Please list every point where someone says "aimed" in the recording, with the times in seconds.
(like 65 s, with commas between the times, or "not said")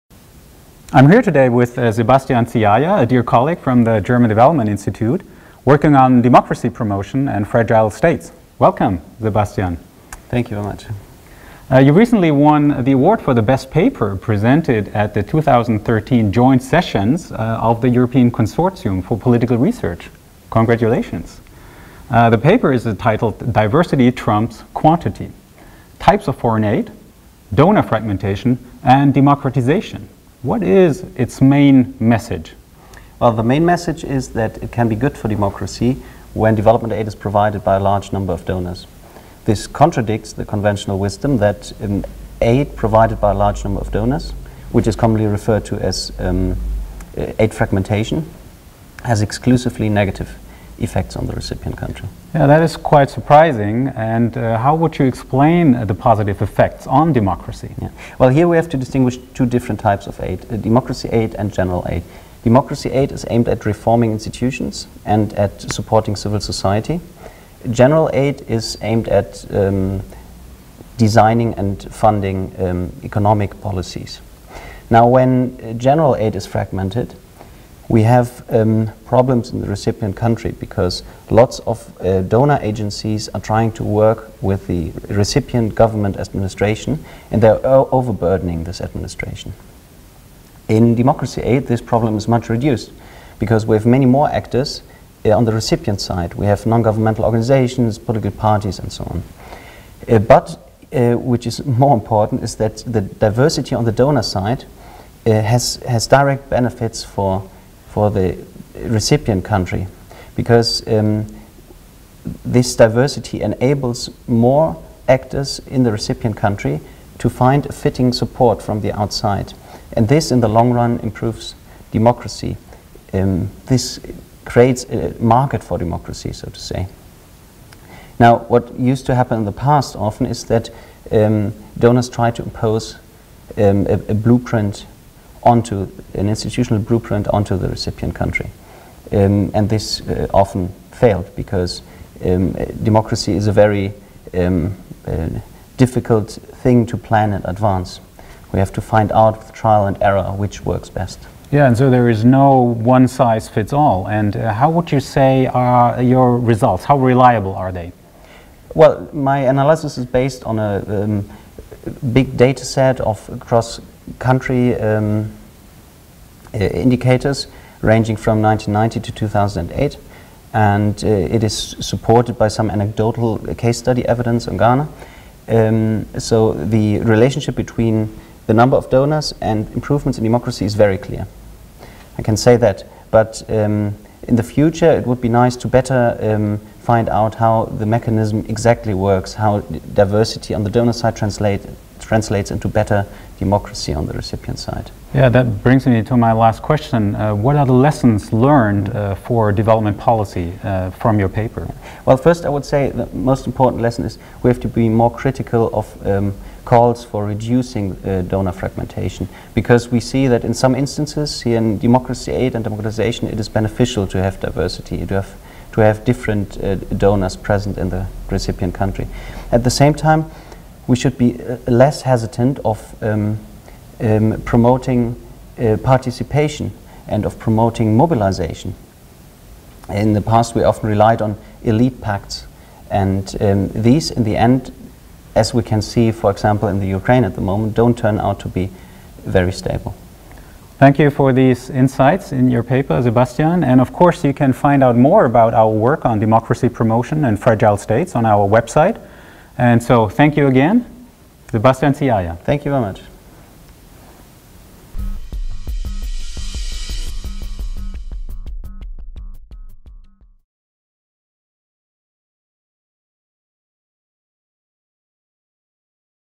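63 s, 68 s.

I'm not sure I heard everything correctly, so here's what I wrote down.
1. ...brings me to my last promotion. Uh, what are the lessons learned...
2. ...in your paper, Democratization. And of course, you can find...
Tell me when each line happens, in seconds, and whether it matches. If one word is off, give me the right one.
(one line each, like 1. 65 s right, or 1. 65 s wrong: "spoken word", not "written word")
1. 195 s wrong: "question", not "promotion"
2. 242 s wrong: "Sebastian", not "Democratization".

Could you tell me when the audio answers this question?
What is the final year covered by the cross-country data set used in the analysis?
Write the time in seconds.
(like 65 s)
169 s.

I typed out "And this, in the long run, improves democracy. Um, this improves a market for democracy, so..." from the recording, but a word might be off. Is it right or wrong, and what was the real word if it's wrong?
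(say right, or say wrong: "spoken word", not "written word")
wrong: "creates", not "improves".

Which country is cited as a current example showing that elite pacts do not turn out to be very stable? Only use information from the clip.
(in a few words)
Ukraine.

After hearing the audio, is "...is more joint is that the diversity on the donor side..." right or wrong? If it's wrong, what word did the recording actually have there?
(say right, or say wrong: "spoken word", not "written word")
wrong: "important", not "joint".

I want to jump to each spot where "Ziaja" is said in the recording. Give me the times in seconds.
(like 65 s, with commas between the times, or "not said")
2 s, 251 s.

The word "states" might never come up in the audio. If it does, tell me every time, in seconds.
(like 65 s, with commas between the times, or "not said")
7 s, 247 s.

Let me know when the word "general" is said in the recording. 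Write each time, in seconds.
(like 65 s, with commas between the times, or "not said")
61 s, 67 s, 75 s.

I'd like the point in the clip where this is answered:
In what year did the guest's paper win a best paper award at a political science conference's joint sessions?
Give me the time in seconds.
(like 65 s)
15 s.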